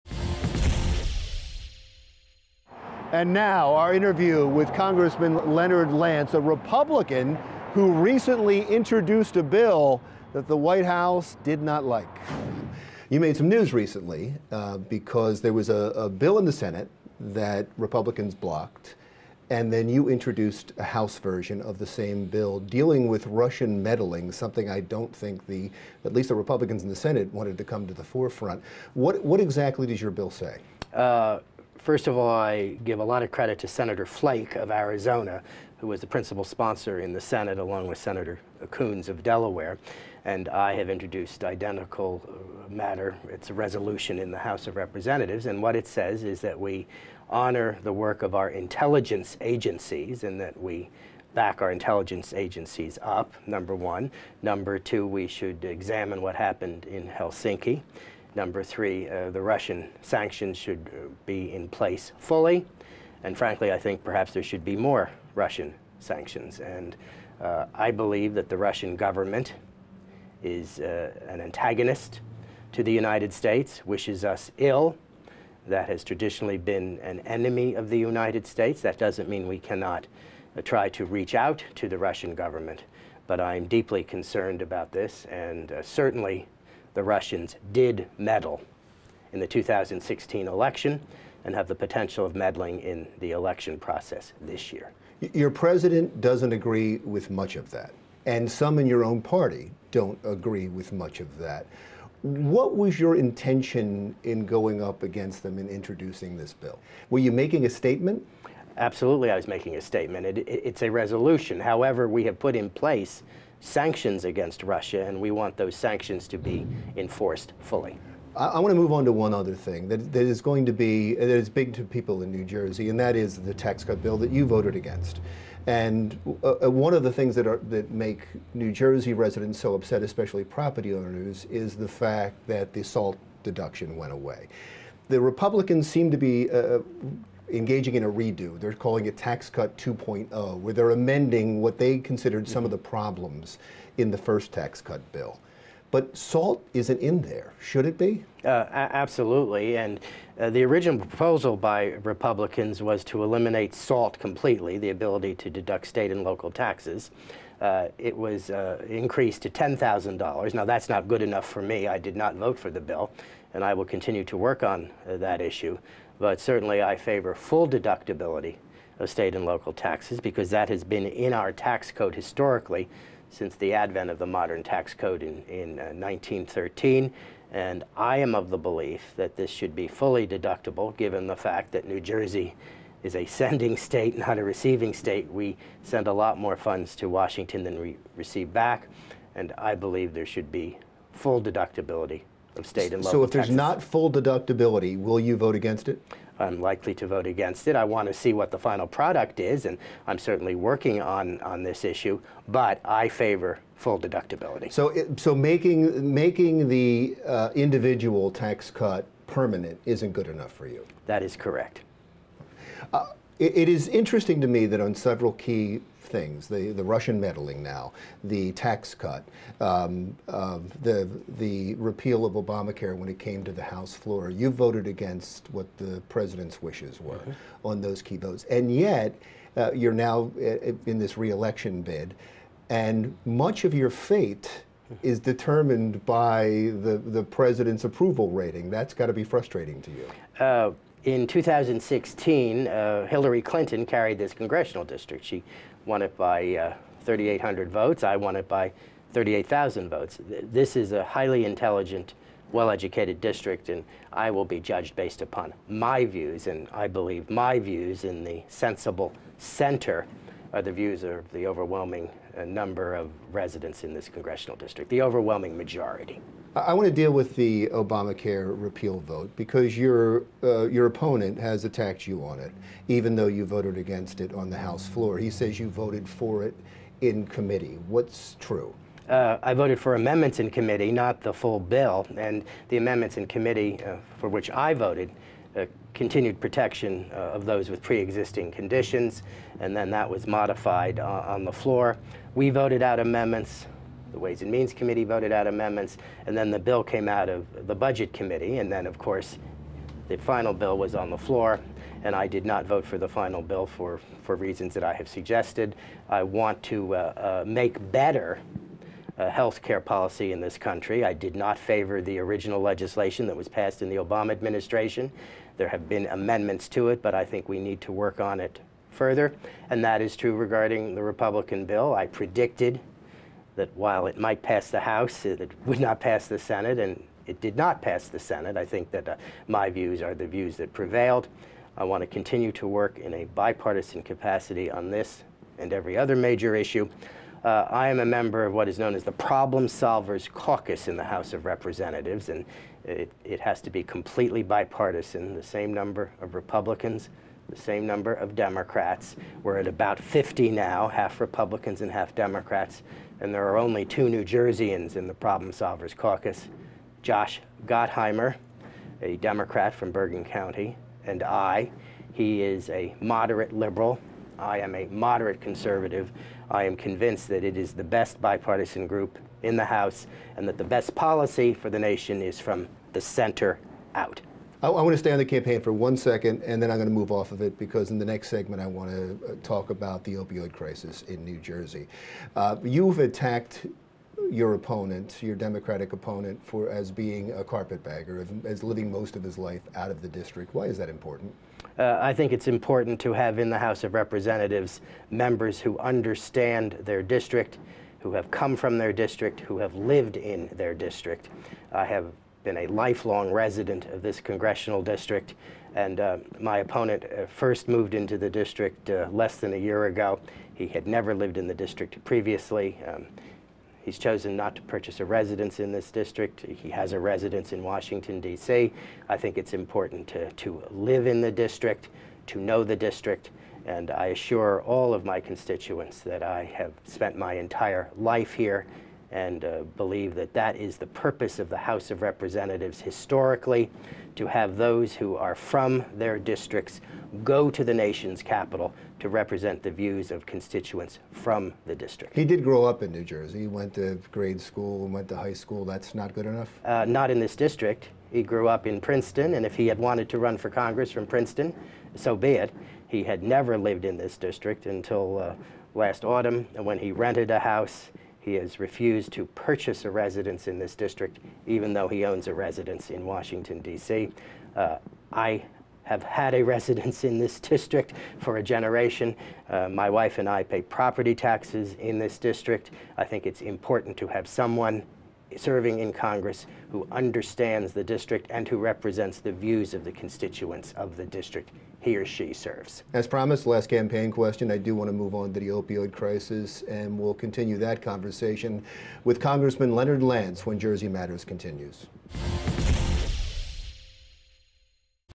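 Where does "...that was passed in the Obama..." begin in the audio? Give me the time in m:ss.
5:13.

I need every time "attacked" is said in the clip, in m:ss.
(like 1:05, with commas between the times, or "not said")
4:31, 6:22.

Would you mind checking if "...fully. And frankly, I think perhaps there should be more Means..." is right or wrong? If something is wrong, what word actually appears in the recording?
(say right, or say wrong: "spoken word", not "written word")
wrong: "Russian", not "Means".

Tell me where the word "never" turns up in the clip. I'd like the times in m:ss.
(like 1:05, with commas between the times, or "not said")
6:50, 7:33.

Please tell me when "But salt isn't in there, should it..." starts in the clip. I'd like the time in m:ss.
2:25.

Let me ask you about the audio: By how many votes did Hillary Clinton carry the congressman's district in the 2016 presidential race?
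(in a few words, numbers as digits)
3,800.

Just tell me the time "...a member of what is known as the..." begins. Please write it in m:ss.
5:37.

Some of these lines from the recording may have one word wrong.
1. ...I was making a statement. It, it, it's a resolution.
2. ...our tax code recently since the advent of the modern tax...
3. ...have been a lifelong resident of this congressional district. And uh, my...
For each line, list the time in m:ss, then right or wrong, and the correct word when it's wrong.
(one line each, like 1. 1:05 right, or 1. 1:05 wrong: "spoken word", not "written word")
1. 1:49 right
2. 2:51 wrong: "historically", not "recently"
3. 6:41 right.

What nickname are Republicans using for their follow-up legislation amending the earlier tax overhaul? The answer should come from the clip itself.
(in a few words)
Tax Cut 2.0.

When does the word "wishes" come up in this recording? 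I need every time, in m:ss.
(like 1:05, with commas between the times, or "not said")
1:13, 3:46.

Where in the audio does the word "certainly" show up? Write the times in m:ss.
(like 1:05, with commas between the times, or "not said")
1:25, 2:46, 3:20.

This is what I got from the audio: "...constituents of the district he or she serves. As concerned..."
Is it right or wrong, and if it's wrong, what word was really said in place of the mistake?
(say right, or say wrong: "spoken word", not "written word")
wrong: "promised", not "concerned".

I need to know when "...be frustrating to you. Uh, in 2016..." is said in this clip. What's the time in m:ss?
3:59.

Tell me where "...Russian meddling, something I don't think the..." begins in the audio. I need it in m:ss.
0:23.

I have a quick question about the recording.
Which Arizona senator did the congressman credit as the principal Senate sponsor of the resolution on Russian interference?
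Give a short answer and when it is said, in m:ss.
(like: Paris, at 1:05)
Senator Flake, at 0:33.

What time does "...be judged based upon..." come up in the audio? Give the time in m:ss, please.
4:14.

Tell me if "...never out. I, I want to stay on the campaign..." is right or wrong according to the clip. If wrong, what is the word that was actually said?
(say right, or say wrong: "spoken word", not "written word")
wrong: "center", not "never".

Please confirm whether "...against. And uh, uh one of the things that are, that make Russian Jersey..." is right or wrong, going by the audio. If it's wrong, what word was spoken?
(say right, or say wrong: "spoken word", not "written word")
wrong: "New", not "Russian".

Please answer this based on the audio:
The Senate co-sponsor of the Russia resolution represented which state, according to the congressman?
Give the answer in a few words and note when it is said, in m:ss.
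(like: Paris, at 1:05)
Delaware, at 0:39.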